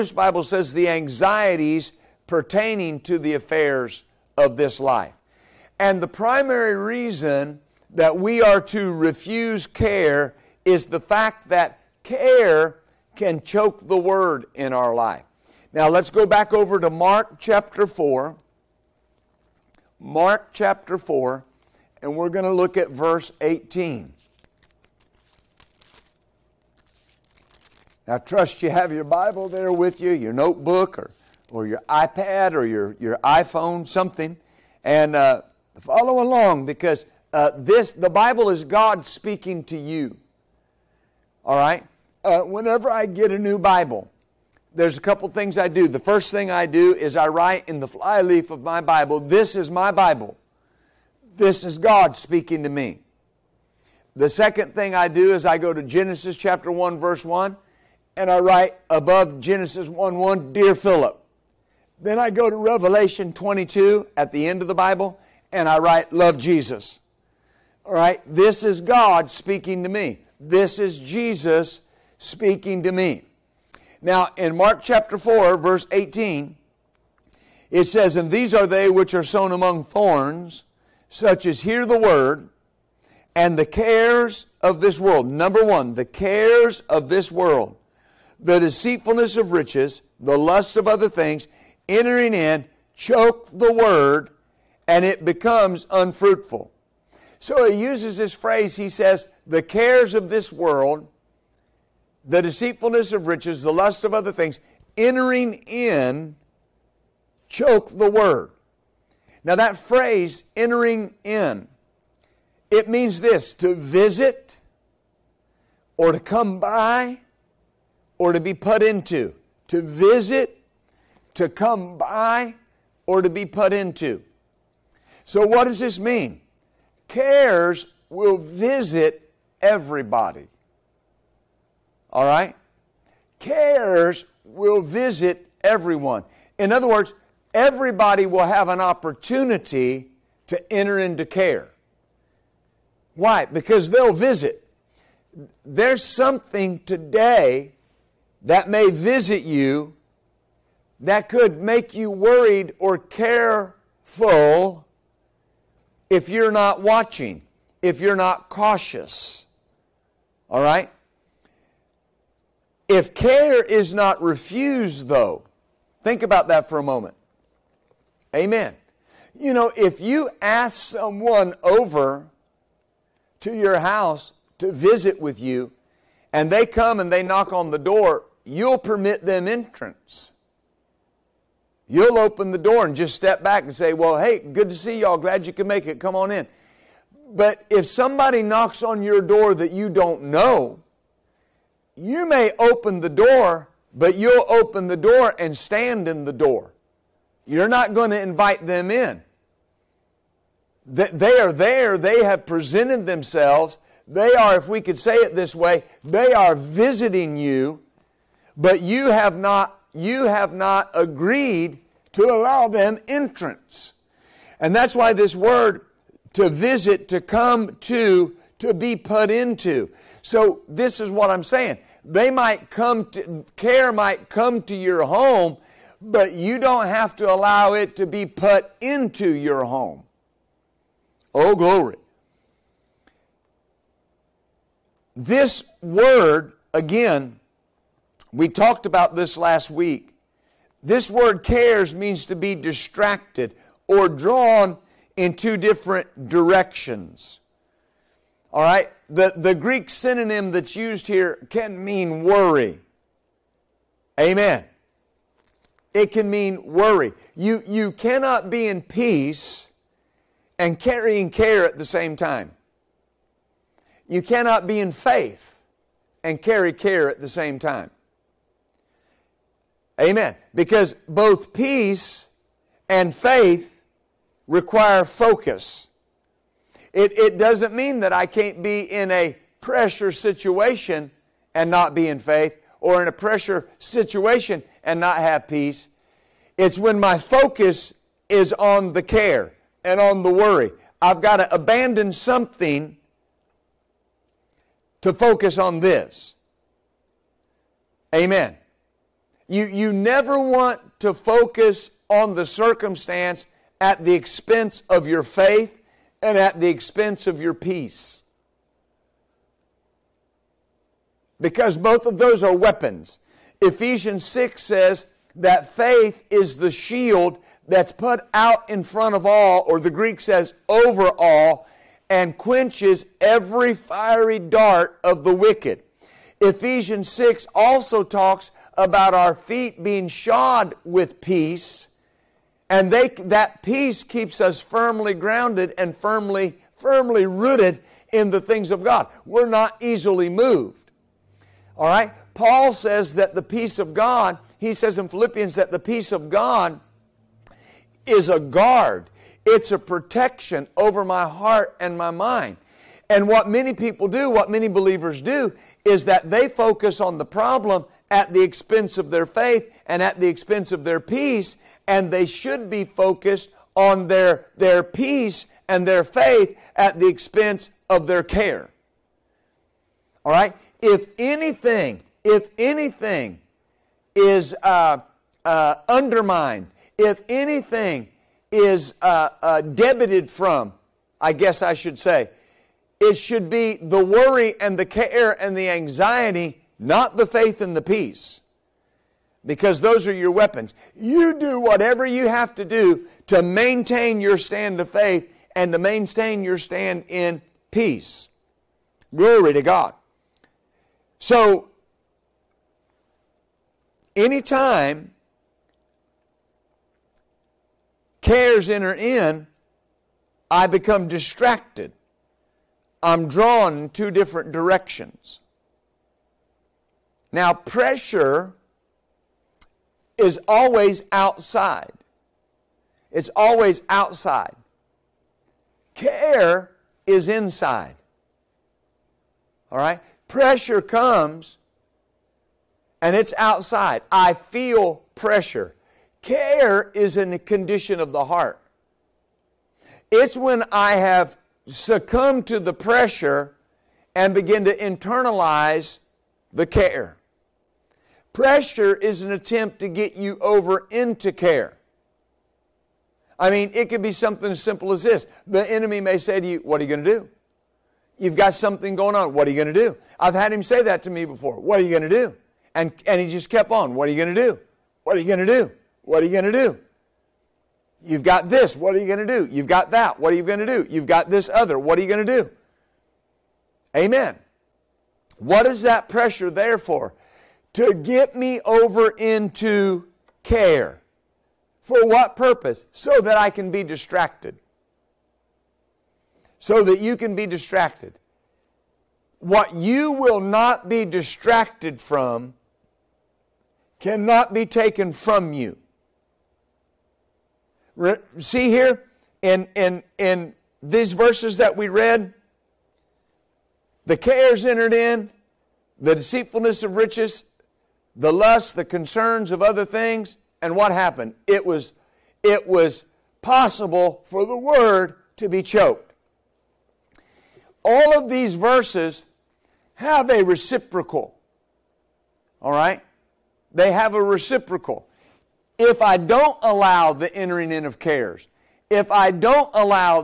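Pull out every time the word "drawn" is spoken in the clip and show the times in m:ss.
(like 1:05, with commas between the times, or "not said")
4:04, 6:53.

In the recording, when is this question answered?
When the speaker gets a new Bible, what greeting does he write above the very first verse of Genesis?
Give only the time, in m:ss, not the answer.
1:00.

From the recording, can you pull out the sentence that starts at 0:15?
Now let's go back over to Mark chapter 4.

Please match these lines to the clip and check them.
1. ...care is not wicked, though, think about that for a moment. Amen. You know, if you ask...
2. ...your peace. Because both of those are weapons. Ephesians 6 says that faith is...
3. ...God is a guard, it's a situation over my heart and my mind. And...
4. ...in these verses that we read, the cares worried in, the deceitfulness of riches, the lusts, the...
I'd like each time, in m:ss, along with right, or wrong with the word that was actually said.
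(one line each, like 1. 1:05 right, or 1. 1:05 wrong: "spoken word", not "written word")
1. 2:43 wrong: "refused", not "wicked"
2. 5:07 right
3. 5:46 wrong: "protection", not "situation"
4. 8:20 wrong: "entered", not "worried".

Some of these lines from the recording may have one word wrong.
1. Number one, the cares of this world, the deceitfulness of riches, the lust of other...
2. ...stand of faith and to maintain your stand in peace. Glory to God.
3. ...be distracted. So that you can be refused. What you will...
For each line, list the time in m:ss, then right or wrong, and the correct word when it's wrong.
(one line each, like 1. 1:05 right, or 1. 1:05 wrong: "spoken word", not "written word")
1. 1:25 right
2. 6:34 right
3. 8:03 wrong: "distracted", not "refused".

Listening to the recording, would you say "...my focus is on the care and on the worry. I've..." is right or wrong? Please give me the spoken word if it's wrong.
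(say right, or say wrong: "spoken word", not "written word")
right.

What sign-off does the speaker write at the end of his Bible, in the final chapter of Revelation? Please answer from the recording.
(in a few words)
Love Jesus.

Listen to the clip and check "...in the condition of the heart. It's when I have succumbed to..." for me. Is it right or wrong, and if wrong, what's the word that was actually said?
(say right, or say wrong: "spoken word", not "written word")
right.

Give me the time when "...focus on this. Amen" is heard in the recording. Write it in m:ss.
4:55.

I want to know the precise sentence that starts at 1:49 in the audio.
Now, that phrase, entering in, it means this to visit, or to come by, or to be put into.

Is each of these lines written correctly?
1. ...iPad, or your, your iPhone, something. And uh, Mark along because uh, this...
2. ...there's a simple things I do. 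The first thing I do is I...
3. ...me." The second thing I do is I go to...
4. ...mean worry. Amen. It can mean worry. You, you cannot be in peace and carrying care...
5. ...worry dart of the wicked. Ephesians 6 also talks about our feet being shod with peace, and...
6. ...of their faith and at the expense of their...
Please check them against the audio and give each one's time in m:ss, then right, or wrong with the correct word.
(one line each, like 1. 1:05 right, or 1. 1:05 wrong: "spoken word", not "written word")
1. 0:31 wrong: "Follow", not "Mark"
2. 0:44 wrong: "couple", not "simple"
3. 0:52 right
4. 4:11 right
5. 5:23 wrong: "fiery", not "worry"
6. 5:58 right.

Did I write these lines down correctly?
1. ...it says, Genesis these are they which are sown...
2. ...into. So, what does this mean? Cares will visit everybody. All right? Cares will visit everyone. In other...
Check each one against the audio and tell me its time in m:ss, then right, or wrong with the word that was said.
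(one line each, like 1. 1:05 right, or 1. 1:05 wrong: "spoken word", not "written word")
1. 1:17 wrong: "And", not "Genesis"
2. 2:03 right.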